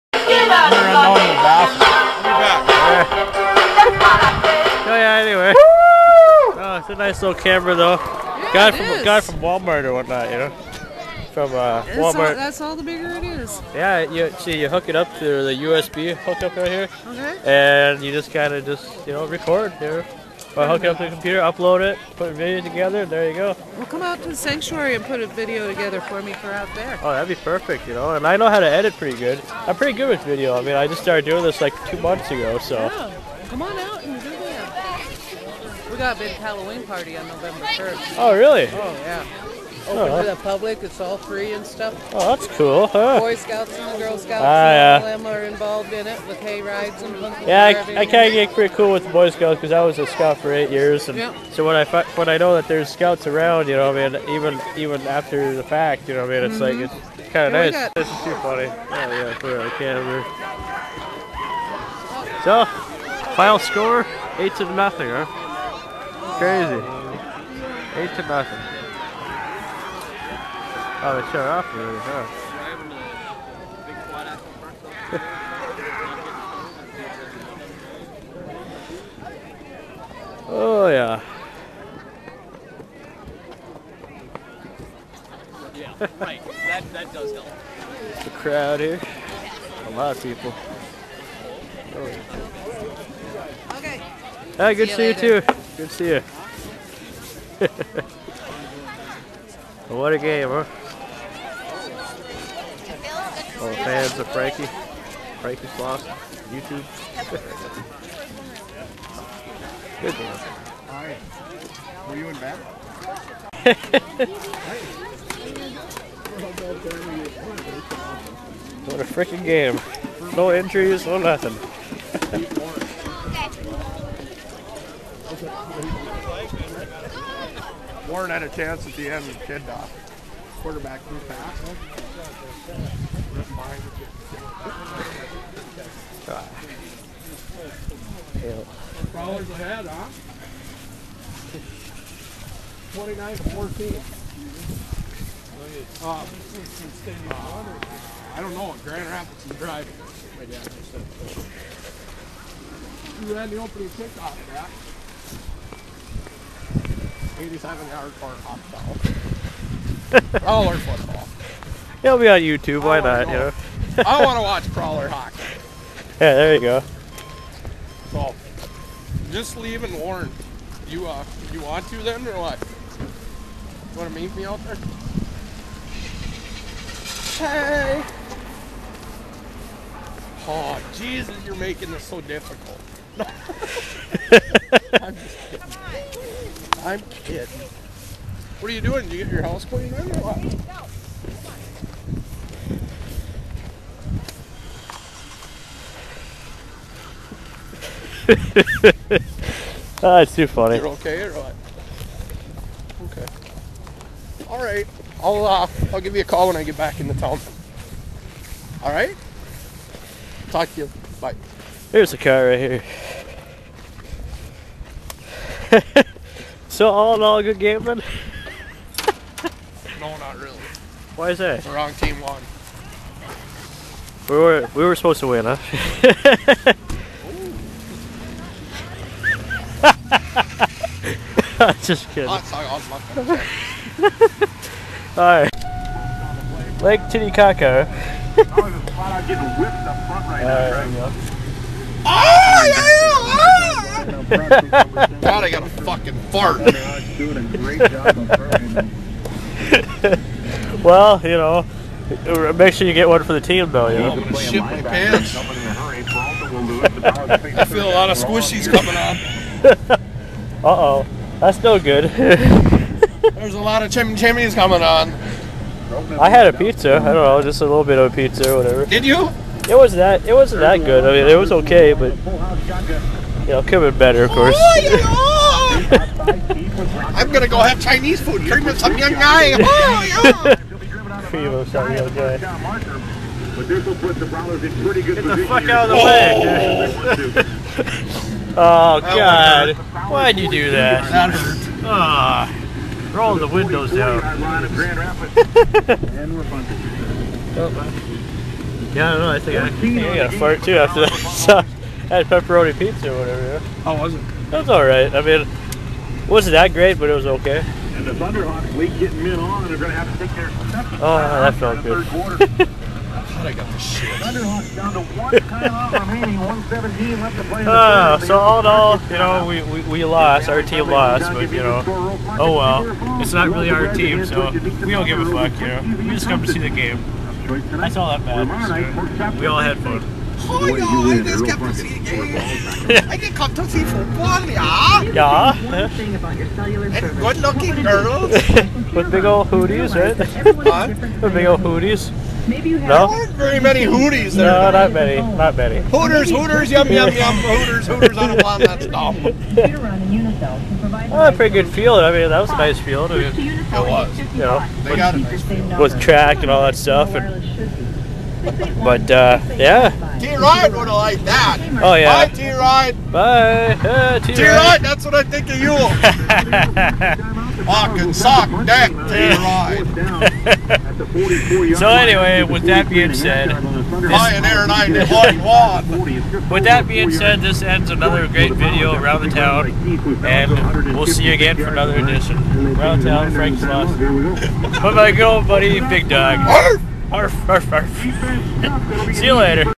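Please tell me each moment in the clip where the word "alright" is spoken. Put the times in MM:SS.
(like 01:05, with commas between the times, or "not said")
03:55, 05:04.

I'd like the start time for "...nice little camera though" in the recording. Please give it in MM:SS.
00:06.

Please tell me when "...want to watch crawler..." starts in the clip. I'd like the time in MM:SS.
02:44.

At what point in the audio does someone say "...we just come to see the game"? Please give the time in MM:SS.
05:26.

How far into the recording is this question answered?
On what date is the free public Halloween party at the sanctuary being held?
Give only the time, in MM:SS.
00:37.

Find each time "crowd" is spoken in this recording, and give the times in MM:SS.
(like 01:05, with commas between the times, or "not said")
01:28.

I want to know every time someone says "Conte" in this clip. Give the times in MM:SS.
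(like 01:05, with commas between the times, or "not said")
not said.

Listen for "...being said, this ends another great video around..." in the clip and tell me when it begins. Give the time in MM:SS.
06:16.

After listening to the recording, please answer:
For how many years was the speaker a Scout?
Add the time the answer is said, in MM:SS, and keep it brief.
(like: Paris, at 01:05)
8 years, at 00:50.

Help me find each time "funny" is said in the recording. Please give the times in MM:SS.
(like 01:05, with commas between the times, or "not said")
00:58, 03:20.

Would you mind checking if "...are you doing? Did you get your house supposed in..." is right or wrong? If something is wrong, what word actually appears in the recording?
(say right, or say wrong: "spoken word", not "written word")
wrong: "cleaned", not "supposed".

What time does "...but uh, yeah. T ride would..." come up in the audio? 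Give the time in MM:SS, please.
05:58.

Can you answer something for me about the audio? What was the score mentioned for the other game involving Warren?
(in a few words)
29 to 14.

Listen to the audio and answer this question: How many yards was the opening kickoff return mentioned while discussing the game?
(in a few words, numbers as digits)
87.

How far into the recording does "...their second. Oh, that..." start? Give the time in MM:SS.
05:10.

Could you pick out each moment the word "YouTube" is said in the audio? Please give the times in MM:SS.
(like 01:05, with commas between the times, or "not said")
01:46, 02:42.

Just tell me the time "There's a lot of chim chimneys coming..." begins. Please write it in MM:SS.
04:22.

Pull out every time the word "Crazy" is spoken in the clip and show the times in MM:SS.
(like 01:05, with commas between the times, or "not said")
01:06.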